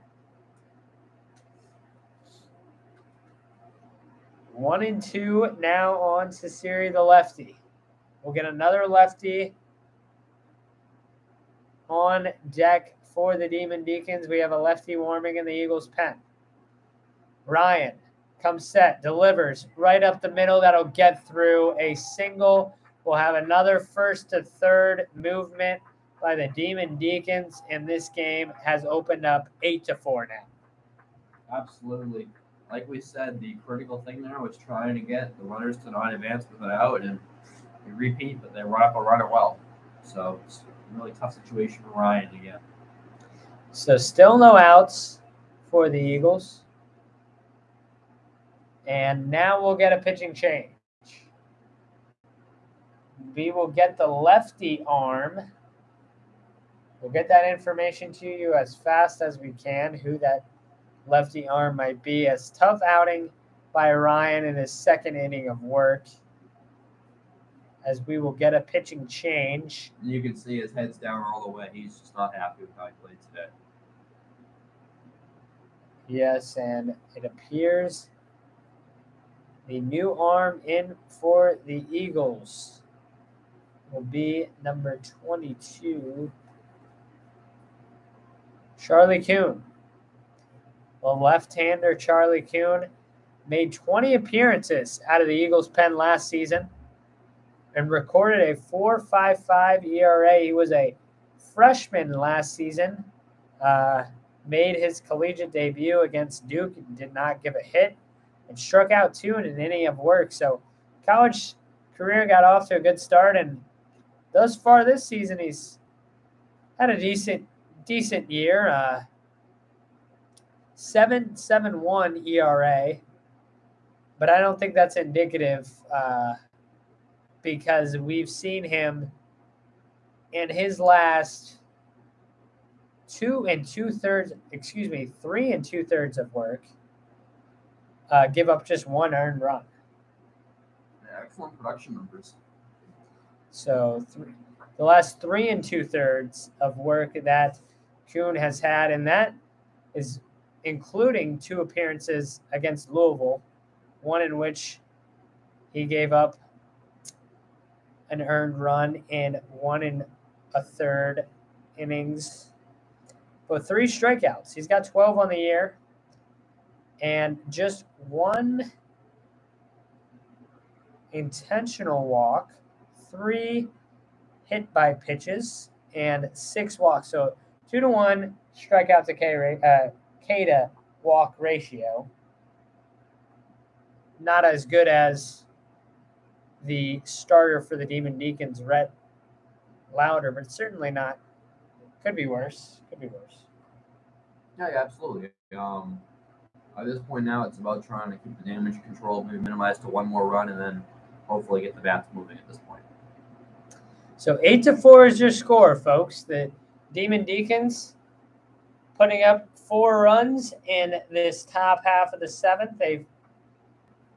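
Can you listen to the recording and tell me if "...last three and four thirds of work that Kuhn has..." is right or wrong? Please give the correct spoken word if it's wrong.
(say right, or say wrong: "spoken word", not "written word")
wrong: "two", not "four".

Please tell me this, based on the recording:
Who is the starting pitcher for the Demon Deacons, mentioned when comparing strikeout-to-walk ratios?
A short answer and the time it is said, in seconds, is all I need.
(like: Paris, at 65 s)
Rhett Lowder, at 188 s.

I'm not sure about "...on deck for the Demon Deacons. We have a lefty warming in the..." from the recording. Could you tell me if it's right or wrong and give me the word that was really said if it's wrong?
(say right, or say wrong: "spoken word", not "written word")
right.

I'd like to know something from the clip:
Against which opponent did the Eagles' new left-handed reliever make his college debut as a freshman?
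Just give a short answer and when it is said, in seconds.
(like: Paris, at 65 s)
Duke, at 106 s.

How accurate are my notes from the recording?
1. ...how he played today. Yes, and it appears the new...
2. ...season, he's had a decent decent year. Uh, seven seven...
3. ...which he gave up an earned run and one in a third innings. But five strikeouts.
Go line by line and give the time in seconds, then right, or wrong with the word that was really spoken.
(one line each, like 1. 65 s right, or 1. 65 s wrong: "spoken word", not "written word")
1. 72 s right
2. 115 s right
3. 154 s wrong: "three", not "five".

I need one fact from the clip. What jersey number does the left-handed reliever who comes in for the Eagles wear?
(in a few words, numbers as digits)
22.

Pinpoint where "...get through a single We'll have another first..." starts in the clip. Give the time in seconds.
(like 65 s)
20 s.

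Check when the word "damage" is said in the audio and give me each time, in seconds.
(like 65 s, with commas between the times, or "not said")
198 s.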